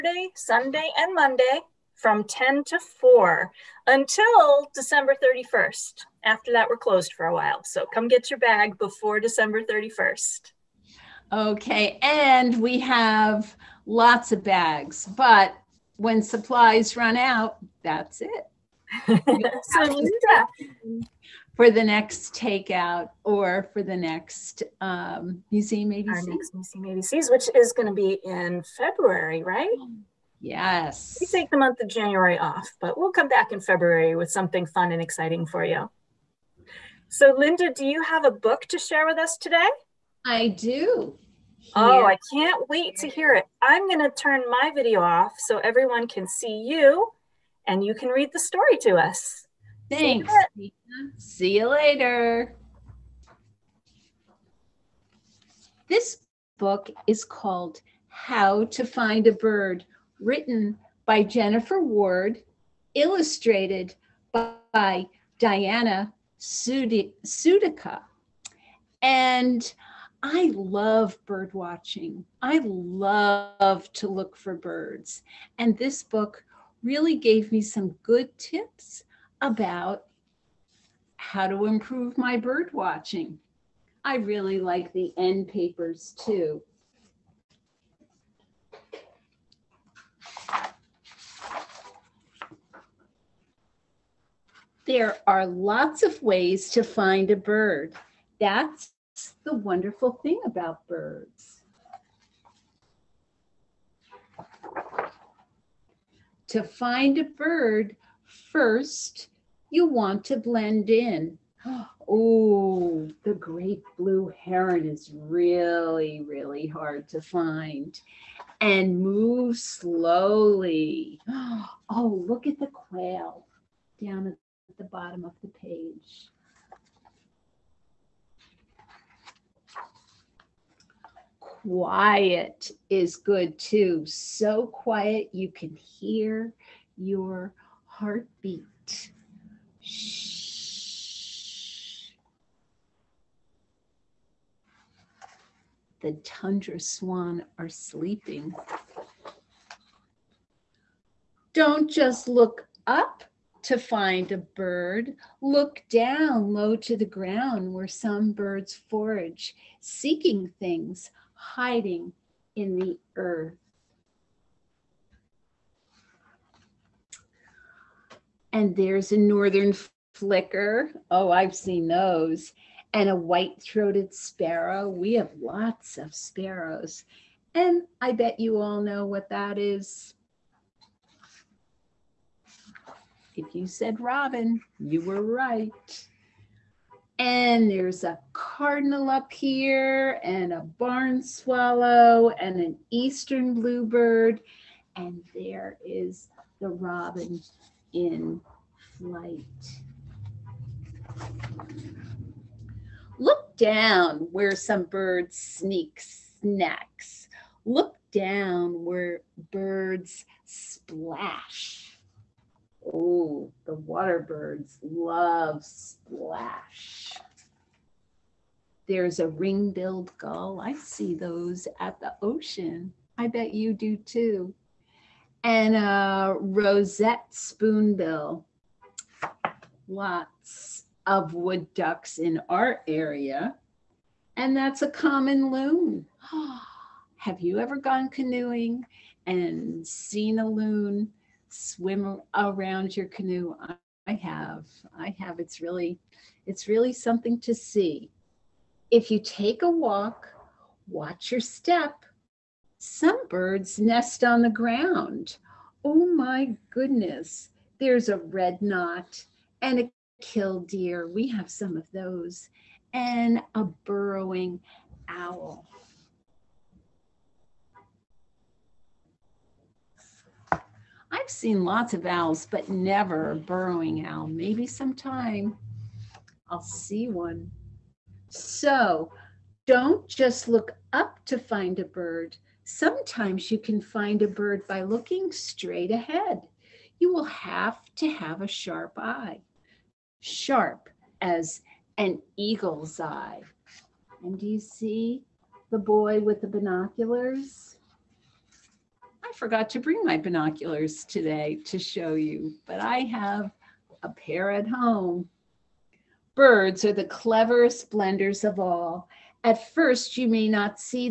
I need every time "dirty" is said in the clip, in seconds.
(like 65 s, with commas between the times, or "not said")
not said.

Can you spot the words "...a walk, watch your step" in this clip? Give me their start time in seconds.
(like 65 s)
249 s.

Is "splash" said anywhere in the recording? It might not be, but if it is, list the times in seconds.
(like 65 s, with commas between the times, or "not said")
210 s, 215 s.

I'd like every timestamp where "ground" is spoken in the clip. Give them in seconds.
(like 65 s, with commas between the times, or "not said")
157 s, 254 s.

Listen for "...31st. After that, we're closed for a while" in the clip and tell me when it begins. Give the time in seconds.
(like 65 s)
5 s.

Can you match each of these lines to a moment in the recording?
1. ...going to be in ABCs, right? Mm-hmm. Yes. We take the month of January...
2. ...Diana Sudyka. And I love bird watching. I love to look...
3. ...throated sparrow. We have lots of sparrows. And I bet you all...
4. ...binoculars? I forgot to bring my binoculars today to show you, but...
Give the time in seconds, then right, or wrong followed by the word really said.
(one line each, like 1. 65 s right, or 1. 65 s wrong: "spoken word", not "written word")
1. 27 s wrong: "February", not "ABCs"
2. 65 s right
3. 173 s right
4. 296 s right.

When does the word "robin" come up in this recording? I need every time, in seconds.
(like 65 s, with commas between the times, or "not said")
183 s, 196 s.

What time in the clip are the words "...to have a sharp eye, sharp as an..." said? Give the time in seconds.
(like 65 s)
287 s.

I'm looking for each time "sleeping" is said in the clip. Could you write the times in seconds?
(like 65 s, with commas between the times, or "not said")
147 s.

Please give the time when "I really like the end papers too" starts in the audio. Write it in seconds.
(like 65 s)
84 s.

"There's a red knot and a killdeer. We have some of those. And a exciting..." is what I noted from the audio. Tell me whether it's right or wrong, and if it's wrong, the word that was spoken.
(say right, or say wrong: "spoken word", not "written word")
wrong: "burrowing", not "exciting".